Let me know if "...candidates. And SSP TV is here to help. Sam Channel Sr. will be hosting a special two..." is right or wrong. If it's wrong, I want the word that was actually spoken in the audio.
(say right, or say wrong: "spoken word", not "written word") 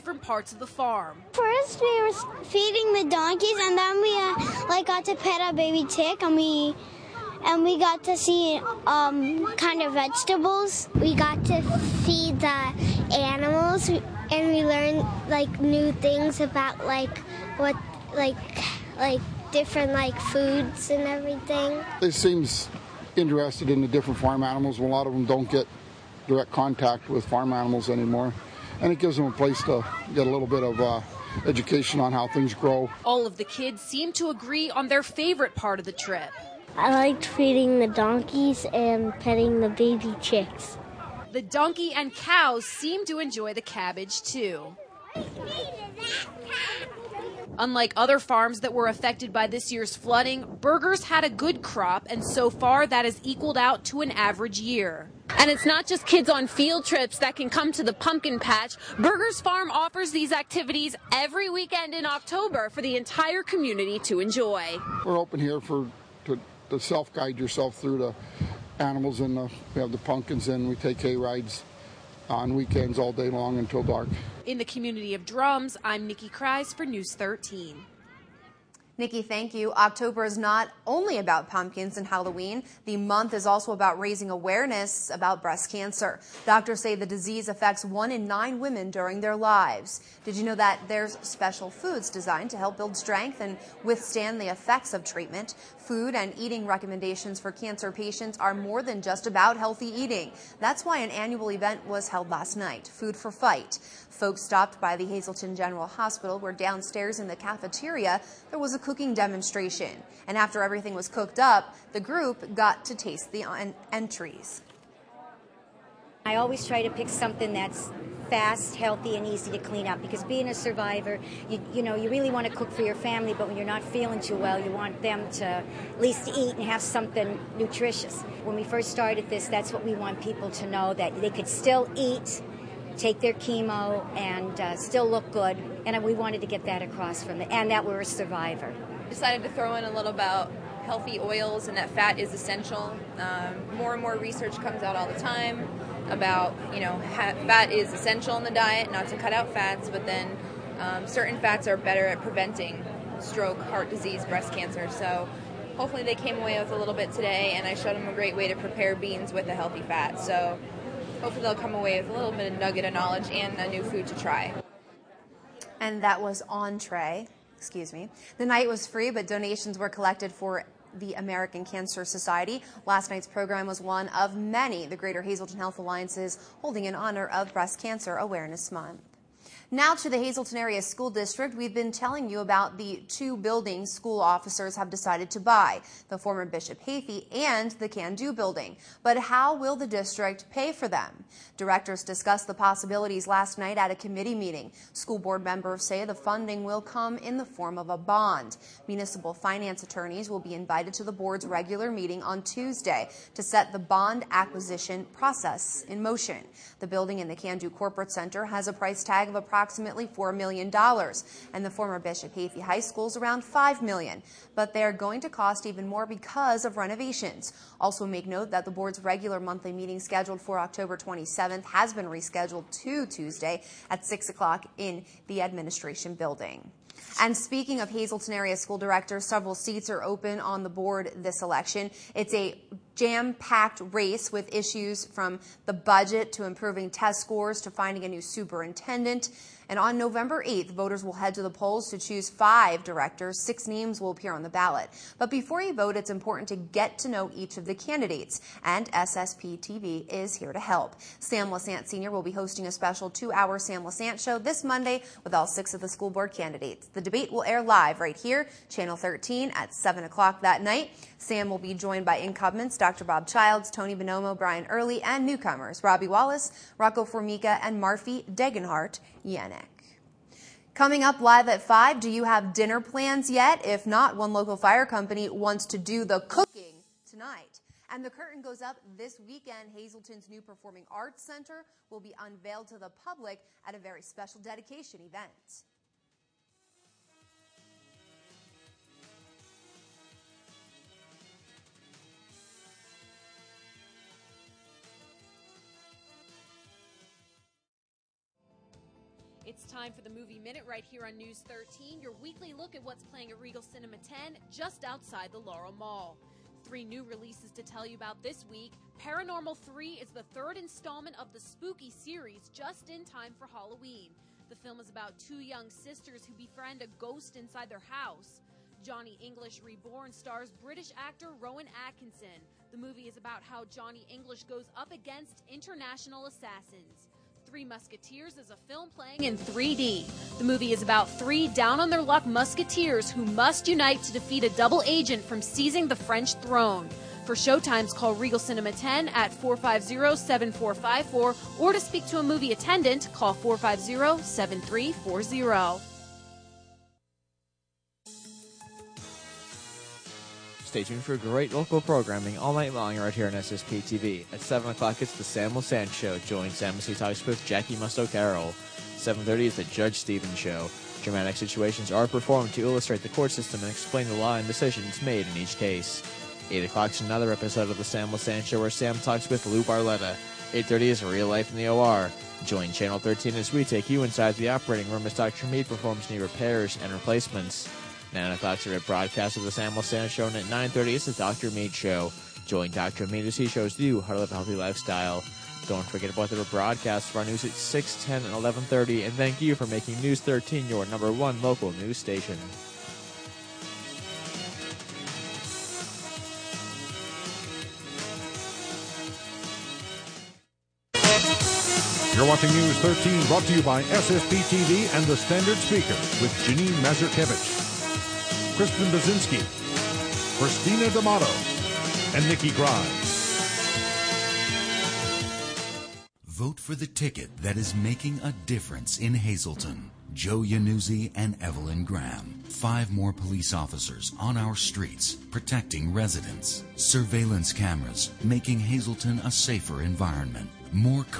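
wrong: "Lesante", not "Channel".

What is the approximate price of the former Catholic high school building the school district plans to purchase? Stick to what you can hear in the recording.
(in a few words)
$5 million.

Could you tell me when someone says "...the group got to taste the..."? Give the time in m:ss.
1:51.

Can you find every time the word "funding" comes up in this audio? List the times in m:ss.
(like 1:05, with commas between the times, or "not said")
3:16.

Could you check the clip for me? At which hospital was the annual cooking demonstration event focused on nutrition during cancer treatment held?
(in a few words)
Hazleton General Hospital.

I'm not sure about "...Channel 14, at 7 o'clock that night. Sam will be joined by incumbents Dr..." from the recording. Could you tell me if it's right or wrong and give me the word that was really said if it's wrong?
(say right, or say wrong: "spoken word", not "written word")
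wrong: "13", not "14".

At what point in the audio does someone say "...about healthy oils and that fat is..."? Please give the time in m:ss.
2:20.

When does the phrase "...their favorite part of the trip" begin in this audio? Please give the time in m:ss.
0:34.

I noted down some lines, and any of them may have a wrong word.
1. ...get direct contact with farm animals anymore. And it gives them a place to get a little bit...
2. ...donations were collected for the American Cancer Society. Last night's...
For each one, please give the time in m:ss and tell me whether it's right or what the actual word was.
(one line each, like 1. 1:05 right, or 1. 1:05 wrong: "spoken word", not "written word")
1. 0:25 right
2. 2:49 right.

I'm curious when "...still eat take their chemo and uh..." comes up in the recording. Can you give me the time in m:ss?
2:11.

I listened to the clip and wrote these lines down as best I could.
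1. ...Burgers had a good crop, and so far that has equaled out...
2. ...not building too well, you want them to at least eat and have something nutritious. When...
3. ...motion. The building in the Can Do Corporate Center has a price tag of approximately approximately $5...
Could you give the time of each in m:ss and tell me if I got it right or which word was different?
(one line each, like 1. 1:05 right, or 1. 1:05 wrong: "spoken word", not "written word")
1. 0:50 right
2. 2:03 wrong: "feeling", not "building"
3. 3:26 wrong: "4", not "5".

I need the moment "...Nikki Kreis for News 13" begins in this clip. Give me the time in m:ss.
1:16.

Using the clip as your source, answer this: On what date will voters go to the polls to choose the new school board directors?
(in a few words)
November 8th.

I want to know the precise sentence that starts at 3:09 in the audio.
But how will the district pay for them?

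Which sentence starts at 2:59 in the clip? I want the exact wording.
Now to the Hazleton Area School District.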